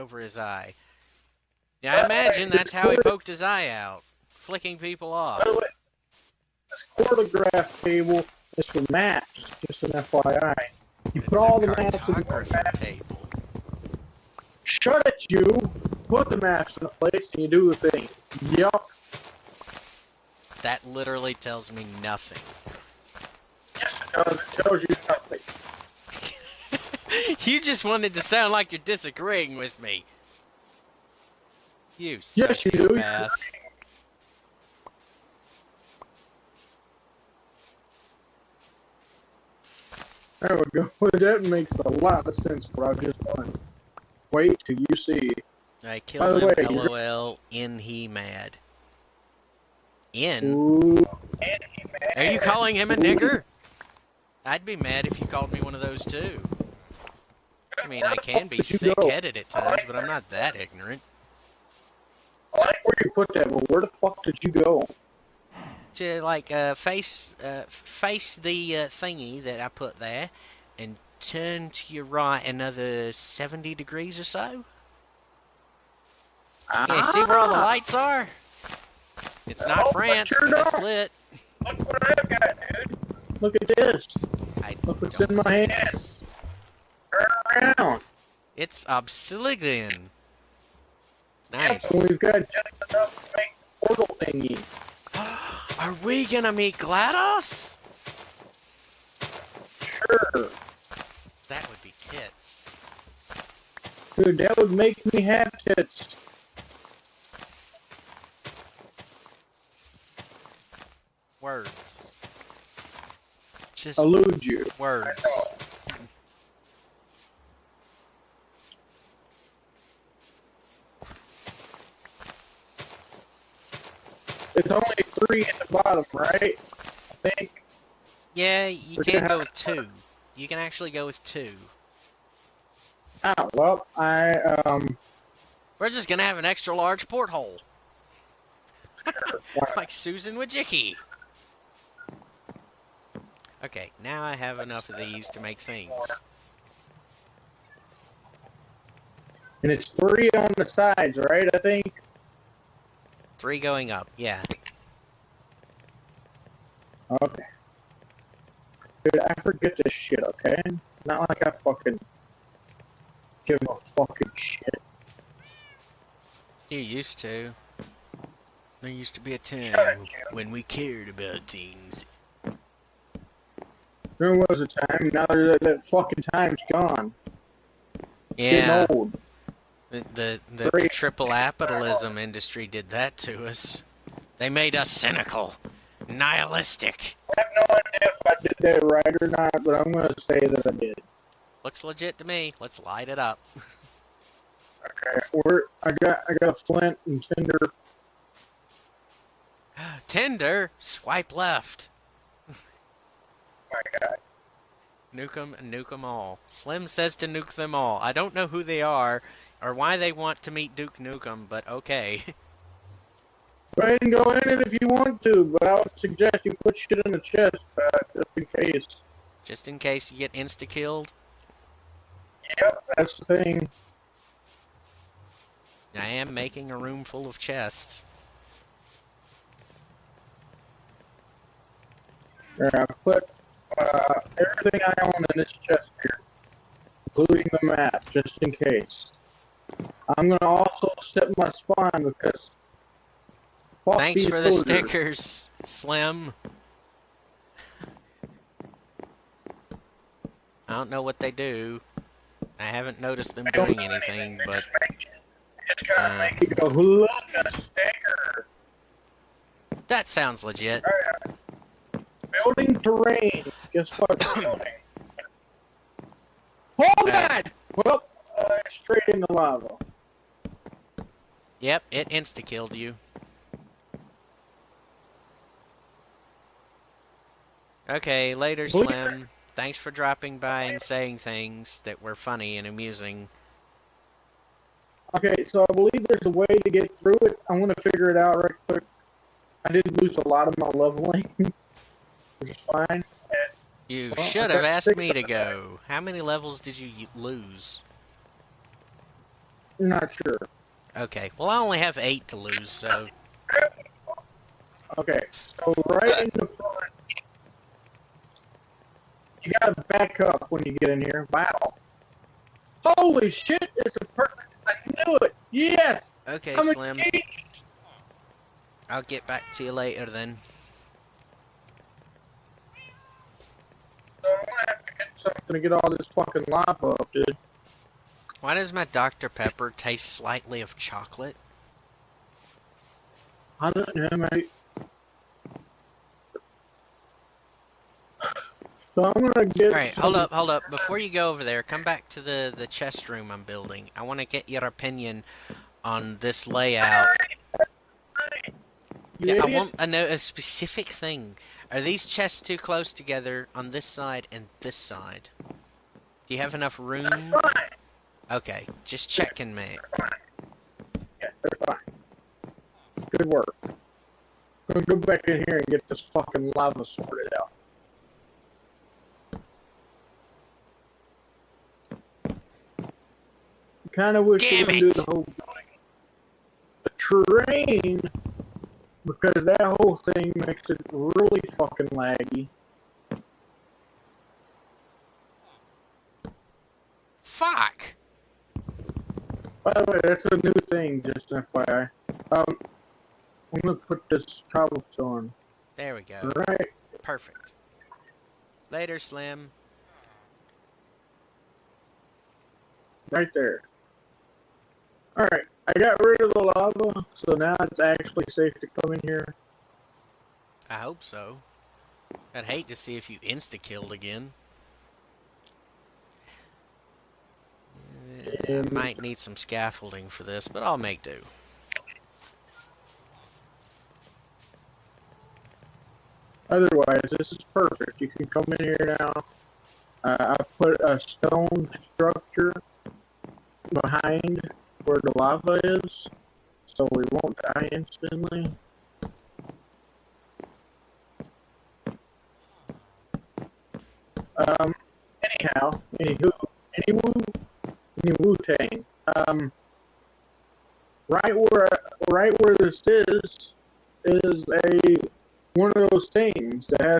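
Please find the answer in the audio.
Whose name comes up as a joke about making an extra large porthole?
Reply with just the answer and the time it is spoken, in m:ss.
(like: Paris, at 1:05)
Susan Wojcicki, at 2:19.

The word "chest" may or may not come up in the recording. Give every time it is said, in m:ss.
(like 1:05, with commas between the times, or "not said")
3:37, 3:47, 3:55, 5:42, 5:52.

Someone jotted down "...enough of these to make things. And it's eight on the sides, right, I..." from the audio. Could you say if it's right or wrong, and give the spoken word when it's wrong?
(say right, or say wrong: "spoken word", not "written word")
wrong: "three", not "eight".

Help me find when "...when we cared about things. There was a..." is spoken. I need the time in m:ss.
2:50.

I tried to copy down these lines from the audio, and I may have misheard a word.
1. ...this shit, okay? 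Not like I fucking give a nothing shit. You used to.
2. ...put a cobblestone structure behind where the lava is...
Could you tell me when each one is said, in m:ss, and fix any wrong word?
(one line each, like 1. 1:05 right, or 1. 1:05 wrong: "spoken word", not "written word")
1. 2:39 wrong: "fucking", not "nothing"
2. 7:10 wrong: "stone", not "cobblestone".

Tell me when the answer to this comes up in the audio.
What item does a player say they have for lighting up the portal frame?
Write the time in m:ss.
3:16.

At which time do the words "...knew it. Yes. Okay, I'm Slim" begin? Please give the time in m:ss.
5:14.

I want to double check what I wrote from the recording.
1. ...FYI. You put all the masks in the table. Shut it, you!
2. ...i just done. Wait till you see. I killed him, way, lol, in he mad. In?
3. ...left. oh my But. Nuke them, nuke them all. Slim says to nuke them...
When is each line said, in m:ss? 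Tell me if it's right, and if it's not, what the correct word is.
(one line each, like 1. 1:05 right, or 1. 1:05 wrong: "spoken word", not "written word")
1. 0:09 right
2. 0:42 right
3. 3:21 wrong: "God", not "But".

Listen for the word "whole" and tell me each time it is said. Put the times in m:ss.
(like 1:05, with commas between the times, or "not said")
6:15, 6:19.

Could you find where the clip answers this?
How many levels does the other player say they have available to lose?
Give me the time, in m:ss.
5:01.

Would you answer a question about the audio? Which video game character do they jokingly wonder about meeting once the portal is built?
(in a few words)
GLaDOS.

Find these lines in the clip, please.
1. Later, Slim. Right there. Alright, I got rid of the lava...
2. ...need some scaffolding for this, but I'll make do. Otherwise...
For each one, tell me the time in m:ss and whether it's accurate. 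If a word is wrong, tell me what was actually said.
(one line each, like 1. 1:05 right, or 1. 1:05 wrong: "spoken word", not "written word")
1. 6:38 right
2. 6:59 right.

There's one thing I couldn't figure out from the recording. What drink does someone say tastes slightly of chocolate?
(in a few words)
Dr. Pepper.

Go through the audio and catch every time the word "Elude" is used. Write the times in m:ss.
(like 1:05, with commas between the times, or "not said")
1:53.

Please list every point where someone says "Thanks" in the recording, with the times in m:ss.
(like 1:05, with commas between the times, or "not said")
4:03, 4:39.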